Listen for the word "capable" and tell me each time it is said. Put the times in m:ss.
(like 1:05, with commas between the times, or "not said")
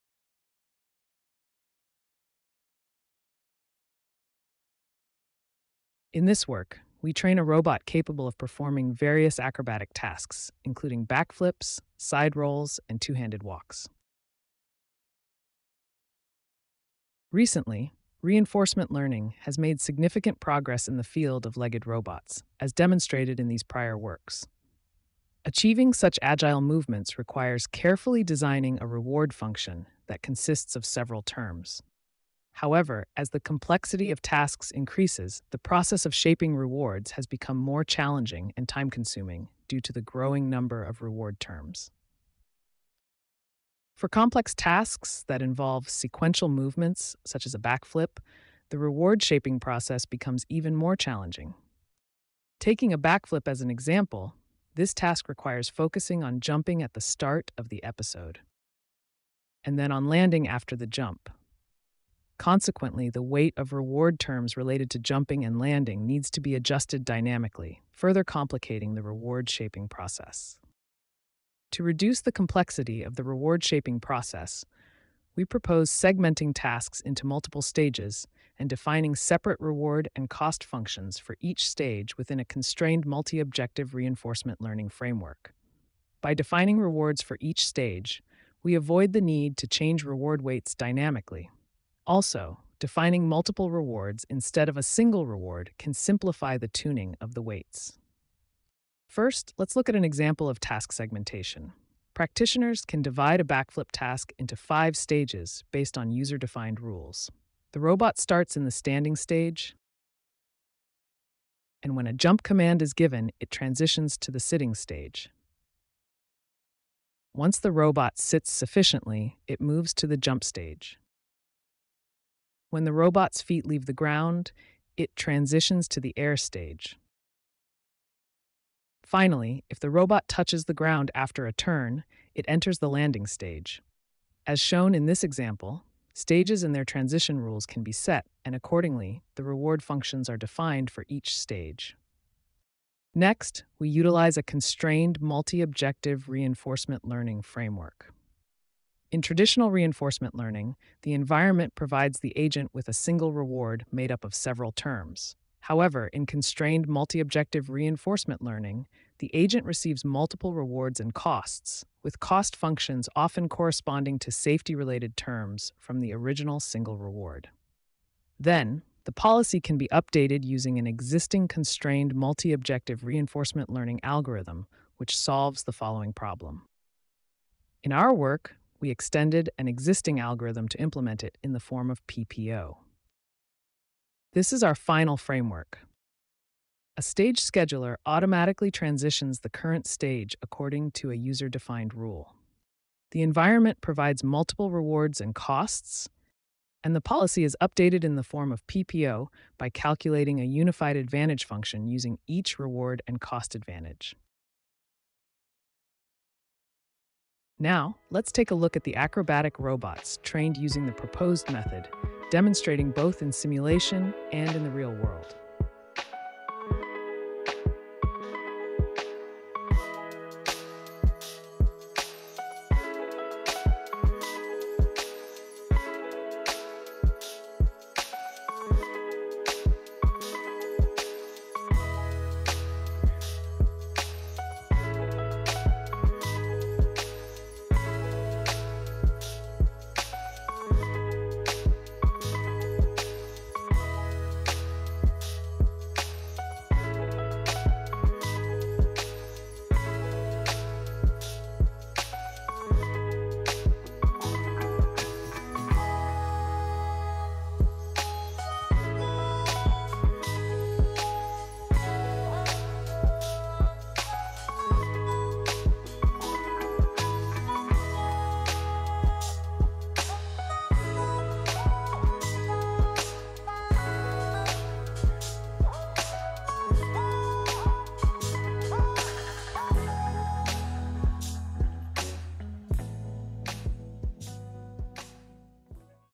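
0:07.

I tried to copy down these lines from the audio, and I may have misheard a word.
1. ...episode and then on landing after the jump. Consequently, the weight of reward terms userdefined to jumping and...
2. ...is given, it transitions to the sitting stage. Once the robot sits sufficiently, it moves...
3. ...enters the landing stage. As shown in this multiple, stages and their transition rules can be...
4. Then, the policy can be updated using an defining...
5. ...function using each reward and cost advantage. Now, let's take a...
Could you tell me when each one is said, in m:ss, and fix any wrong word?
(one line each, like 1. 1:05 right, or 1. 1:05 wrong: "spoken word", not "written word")
1. 0:57 wrong: "related", not "userdefined"
2. 1:52 right
3. 2:12 wrong: "example", not "multiple"
4. 2:48 wrong: "existing", not "defining"
5. 3:21 right.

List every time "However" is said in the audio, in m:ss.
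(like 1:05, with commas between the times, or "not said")
0:32, 2:35.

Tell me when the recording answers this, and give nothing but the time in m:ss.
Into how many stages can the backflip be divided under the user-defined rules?
1:44.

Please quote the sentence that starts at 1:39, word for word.
First, let's look at an example of task segmentation.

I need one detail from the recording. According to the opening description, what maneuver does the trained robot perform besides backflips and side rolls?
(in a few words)
two handed walks.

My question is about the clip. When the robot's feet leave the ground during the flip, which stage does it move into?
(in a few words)
air stage.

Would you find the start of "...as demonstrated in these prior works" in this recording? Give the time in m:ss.
0:22.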